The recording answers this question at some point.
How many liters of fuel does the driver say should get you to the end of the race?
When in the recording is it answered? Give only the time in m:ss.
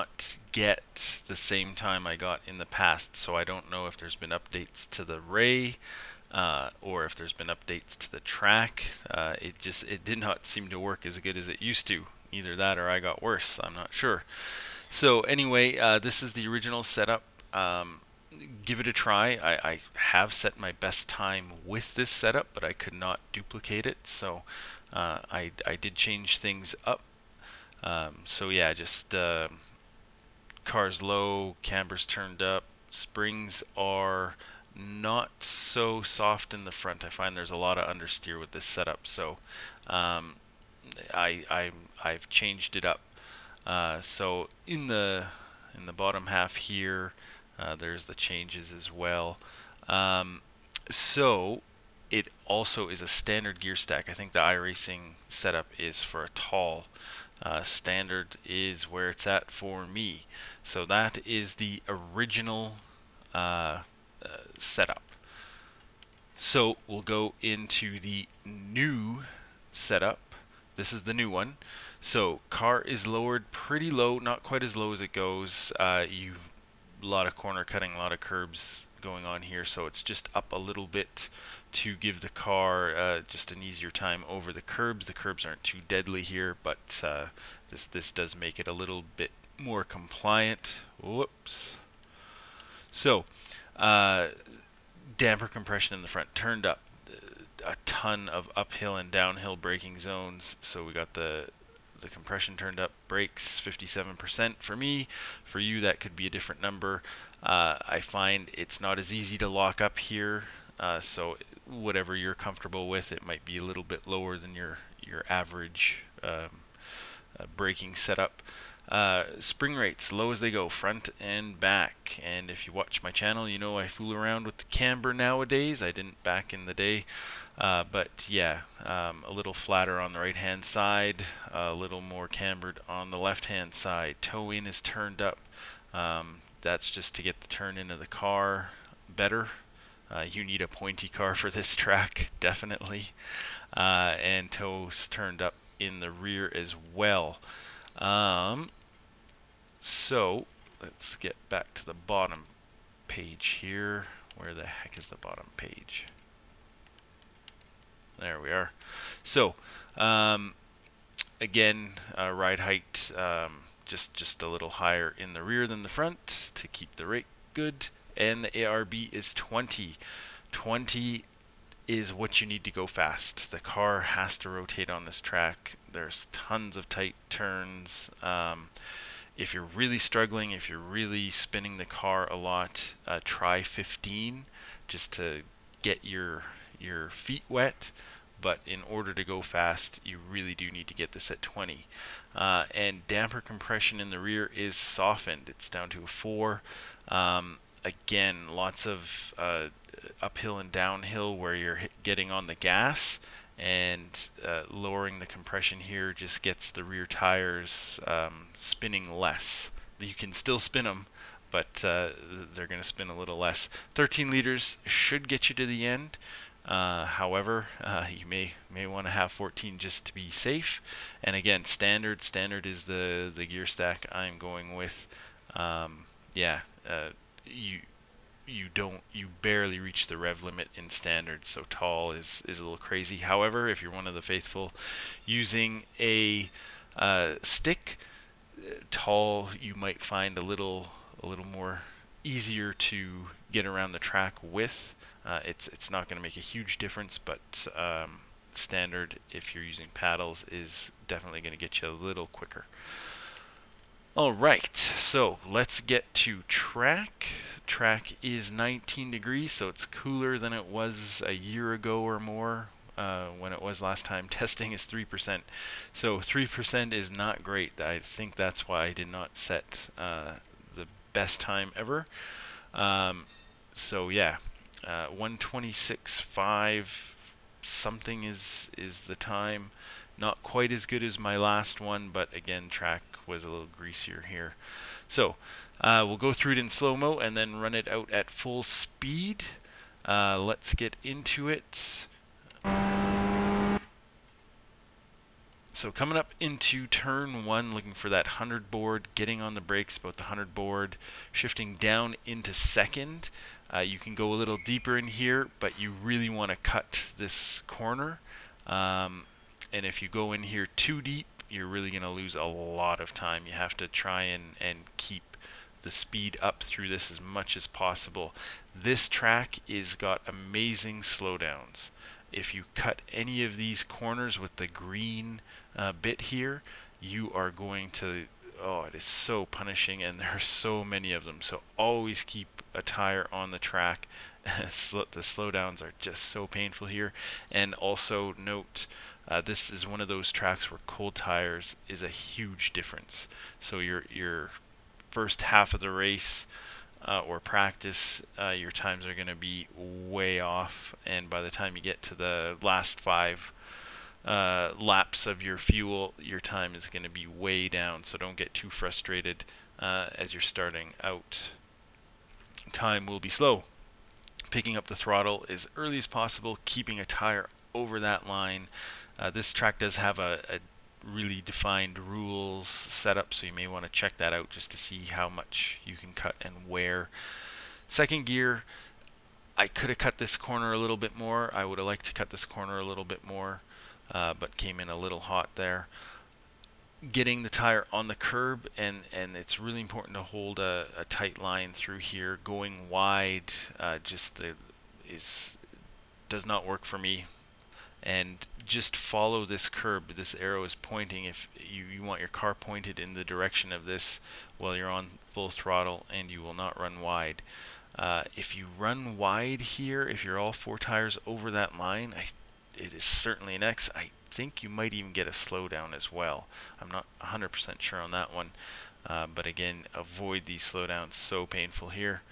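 3:33.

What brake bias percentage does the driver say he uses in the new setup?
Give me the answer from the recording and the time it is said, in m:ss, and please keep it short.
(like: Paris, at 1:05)
57%, at 1:43.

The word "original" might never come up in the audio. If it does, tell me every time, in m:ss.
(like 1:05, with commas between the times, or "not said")
0:16, 1:01.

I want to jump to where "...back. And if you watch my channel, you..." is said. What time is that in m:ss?
2:01.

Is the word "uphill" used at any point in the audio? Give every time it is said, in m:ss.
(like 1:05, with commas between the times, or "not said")
1:38, 3:20.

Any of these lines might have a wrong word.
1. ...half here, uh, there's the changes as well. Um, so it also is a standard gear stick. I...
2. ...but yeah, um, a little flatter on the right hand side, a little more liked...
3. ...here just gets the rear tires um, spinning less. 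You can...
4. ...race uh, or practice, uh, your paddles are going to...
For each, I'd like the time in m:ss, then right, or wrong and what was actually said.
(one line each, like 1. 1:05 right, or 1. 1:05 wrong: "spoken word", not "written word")
1. 0:46 wrong: "stack", not "stick"
2. 2:07 wrong: "cambered", not "liked"
3. 3:25 right
4. 5:45 wrong: "times", not "paddles".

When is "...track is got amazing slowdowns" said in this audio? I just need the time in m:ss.
5:19.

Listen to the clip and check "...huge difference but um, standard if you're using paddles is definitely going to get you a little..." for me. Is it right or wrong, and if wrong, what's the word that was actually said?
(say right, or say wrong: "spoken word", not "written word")
right.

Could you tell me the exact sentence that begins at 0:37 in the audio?
I find there's a lot of understeer with this setup, so um, I, I I've changed it up.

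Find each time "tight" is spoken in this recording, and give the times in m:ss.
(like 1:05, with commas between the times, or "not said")
2:56, 6:31.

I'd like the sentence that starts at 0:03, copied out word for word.
So I don't know if there's been updates to the ray uh, or if there's been updates to the track.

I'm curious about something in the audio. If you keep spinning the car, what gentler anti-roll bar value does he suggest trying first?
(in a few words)
15.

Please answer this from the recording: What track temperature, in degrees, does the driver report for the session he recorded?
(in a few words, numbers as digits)
19 degrees.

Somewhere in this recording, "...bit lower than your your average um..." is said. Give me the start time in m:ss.
1:53.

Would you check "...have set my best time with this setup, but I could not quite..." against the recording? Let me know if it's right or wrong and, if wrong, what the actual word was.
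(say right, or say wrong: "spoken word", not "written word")
wrong: "duplicate", not "quite".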